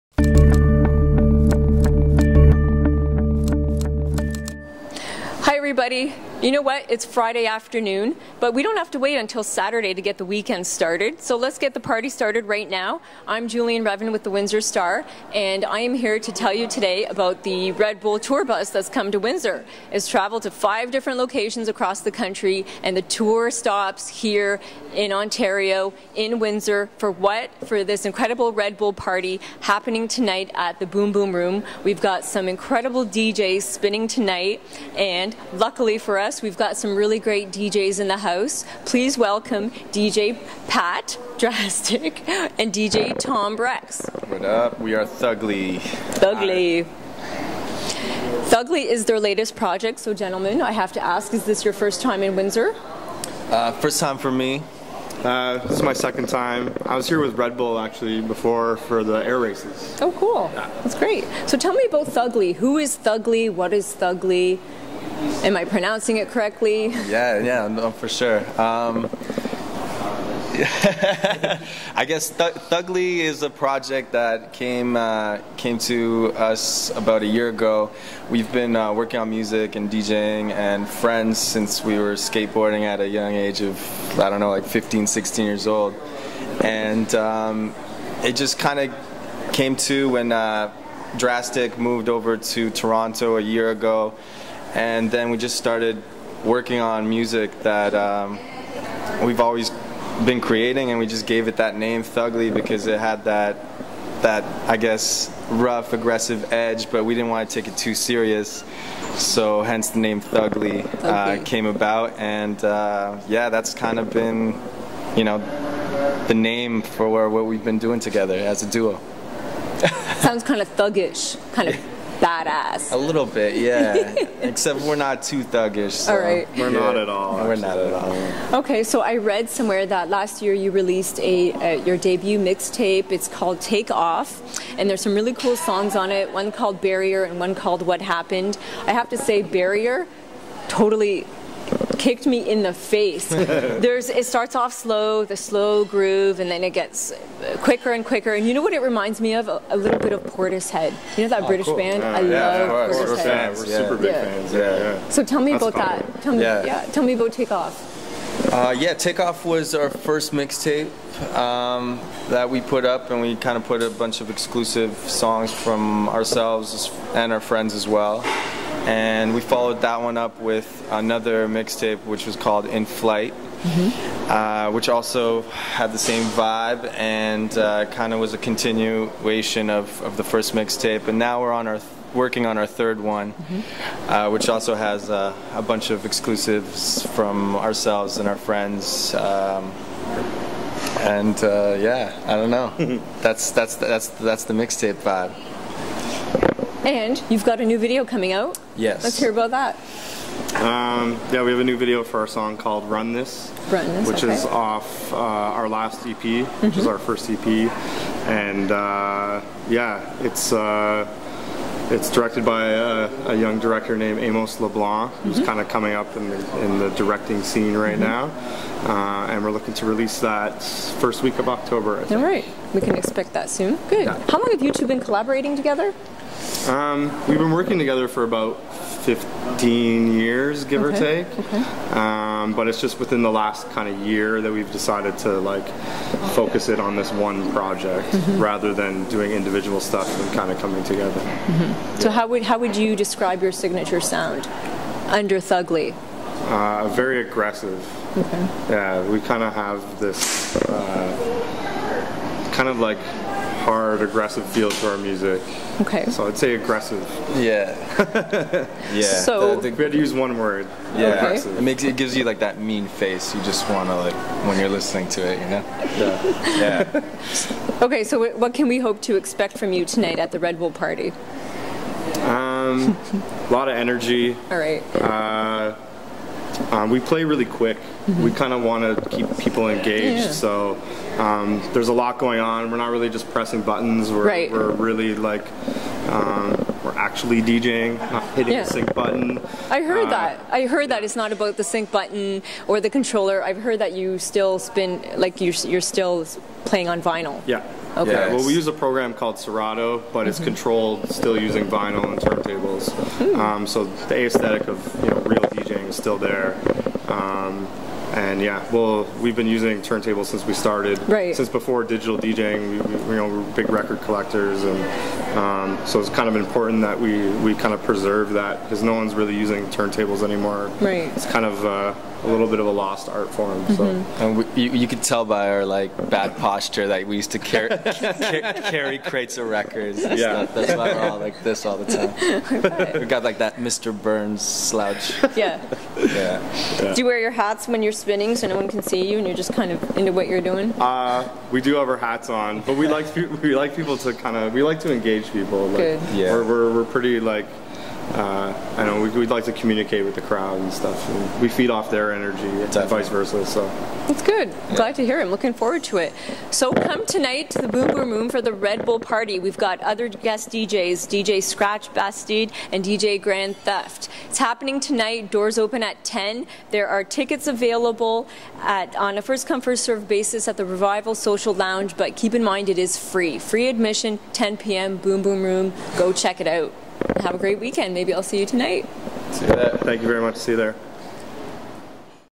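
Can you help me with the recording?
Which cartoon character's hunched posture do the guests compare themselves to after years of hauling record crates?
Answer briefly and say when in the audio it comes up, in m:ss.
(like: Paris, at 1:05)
Mr. Burns, at 5:33.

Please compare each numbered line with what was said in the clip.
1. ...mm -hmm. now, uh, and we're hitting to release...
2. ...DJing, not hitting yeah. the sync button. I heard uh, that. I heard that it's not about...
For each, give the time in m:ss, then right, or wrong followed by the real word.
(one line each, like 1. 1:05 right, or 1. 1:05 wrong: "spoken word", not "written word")
1. 3:37 wrong: "looking", not "hitting"
2. 4:47 right.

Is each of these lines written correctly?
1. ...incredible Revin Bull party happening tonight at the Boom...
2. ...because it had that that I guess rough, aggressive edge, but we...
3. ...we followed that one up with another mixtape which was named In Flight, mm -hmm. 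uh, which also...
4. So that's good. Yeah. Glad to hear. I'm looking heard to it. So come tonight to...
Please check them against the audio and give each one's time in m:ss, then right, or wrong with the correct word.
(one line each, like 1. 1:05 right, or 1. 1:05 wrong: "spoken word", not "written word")
1. 0:28 wrong: "Red", not "Revin"
2. 1:42 right
3. 2:49 wrong: "called", not "named"
4. 5:53 wrong: "forward", not "heard".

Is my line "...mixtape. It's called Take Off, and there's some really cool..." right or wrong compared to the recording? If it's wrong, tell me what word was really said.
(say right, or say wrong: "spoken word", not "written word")
right.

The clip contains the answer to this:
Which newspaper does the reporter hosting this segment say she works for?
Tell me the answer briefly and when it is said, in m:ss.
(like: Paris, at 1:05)
Windsor Star, at 0:14.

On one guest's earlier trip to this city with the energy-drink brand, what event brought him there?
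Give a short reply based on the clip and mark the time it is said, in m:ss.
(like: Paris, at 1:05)
the air races, at 0:59.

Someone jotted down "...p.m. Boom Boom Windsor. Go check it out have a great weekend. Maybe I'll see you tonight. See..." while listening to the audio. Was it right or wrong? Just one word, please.
wrong.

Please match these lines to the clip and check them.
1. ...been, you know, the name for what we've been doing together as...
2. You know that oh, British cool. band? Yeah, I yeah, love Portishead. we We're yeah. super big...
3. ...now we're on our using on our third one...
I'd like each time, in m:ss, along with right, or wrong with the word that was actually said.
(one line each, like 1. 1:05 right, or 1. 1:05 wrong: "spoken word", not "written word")
1. 1:54 right
2. 2:31 right
3. 3:01 wrong: "working", not "using".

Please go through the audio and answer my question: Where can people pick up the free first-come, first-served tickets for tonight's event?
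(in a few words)
Revival Social Lounge.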